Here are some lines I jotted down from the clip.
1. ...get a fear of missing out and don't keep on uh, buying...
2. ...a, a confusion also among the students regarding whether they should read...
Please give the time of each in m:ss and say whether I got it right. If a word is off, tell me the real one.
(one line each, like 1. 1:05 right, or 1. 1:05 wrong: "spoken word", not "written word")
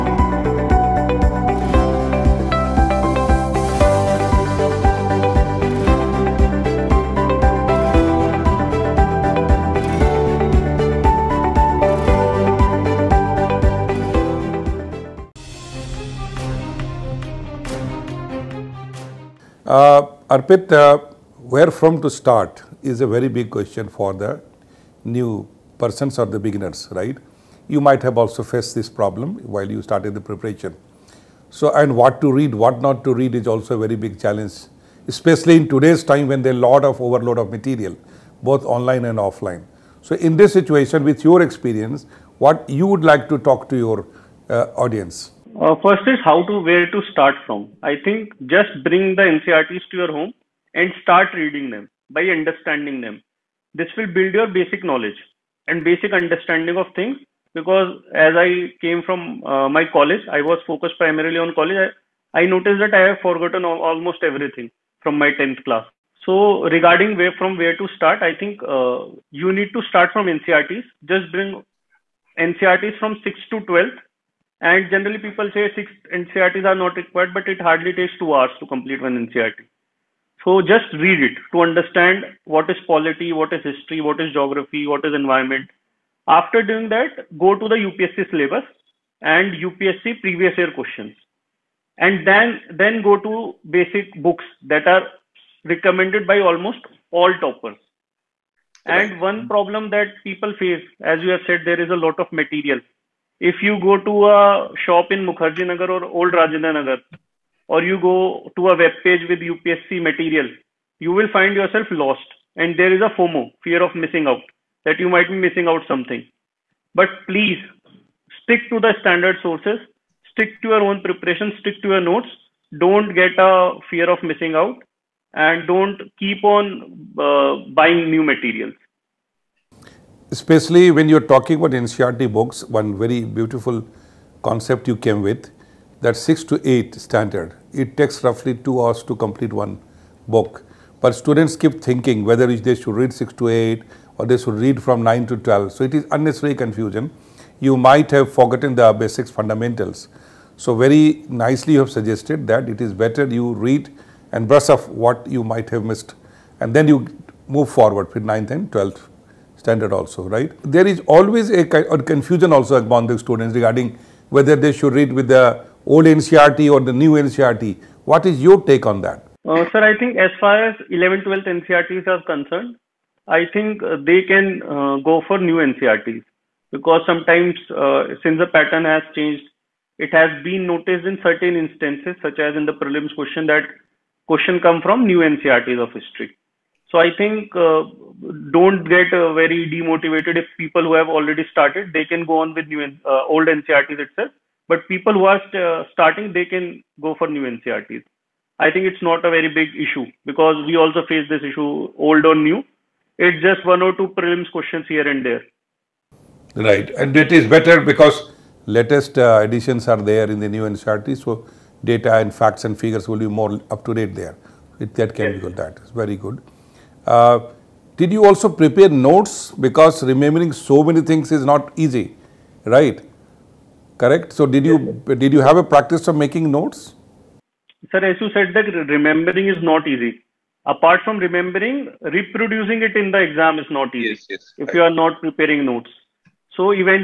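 1. 2:03 right
2. 2:41 right.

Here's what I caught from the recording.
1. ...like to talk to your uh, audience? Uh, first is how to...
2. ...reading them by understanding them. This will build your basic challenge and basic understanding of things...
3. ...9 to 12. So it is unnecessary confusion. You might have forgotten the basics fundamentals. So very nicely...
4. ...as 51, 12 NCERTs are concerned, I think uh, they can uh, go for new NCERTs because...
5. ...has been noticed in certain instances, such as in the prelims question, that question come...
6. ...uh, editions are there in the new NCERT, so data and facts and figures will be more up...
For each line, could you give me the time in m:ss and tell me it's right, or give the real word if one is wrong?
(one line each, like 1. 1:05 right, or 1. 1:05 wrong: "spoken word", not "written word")
1. 0:43 right
2. 0:51 wrong: "knowledge", not "challenge"
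3. 2:25 right
4. 2:50 wrong: "11", not "51"
5. 3:00 right
6. 3:29 right.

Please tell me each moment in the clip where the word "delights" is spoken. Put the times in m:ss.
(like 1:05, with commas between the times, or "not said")
not said.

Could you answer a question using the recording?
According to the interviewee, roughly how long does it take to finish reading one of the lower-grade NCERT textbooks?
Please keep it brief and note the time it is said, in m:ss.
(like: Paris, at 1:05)
2 hours, at 1:18.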